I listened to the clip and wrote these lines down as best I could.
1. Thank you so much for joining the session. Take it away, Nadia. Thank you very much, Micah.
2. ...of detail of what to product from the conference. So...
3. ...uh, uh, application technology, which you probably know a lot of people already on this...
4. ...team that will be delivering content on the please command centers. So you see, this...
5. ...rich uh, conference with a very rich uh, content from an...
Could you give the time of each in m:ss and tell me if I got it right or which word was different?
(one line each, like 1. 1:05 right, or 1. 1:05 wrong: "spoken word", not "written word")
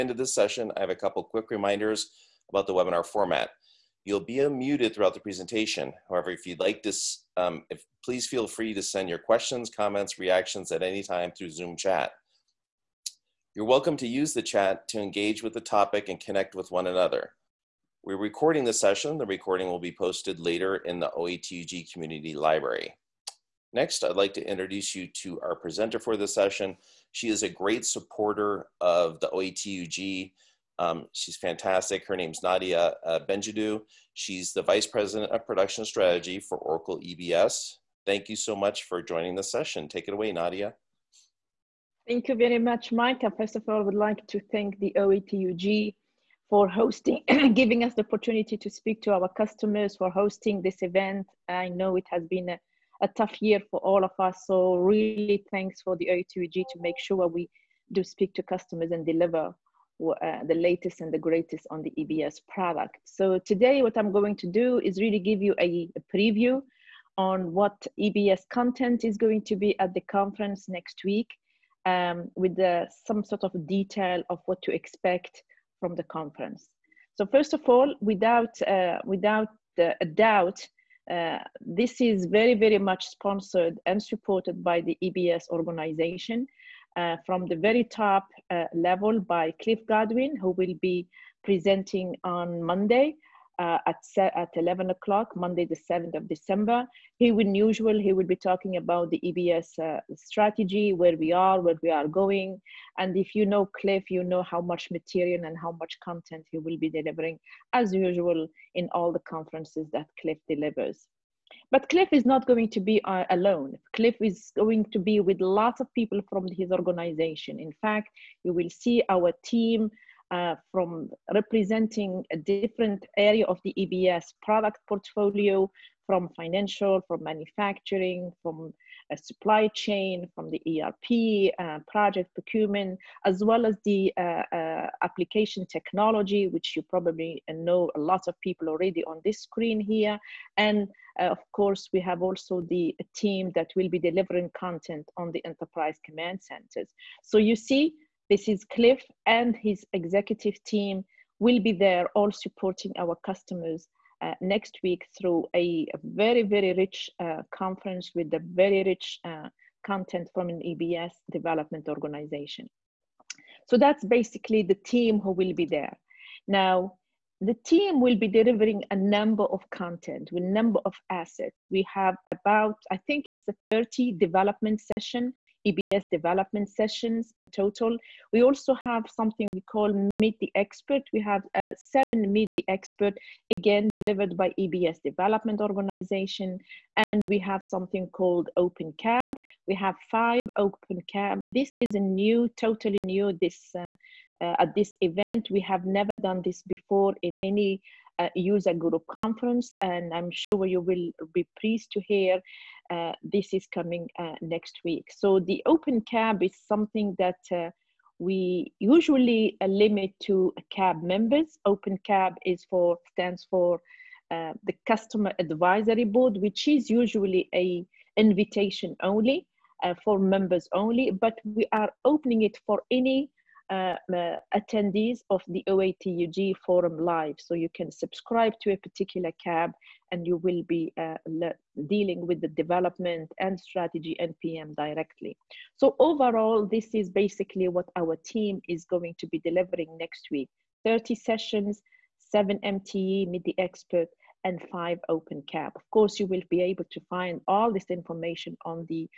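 1. 0:38 right
2. 1:13 wrong: "expect", not "product"
3. 2:14 right
4. 2:23 wrong: "enterprise", not "please"
5. 2:36 right.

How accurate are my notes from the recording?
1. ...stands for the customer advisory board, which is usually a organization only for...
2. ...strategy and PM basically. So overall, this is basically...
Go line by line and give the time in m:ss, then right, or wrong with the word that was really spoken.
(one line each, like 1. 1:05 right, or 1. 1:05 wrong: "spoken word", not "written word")
1. 3:33 wrong: "invitation", not "organization"
2. 3:53 wrong: "directly", not "basically".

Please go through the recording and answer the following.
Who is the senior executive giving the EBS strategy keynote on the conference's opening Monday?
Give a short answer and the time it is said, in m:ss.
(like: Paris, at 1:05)
Cliff Godwin, at 1:29.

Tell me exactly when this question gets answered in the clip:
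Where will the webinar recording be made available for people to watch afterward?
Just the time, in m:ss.
0:21.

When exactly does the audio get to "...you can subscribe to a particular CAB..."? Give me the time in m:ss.
3:47.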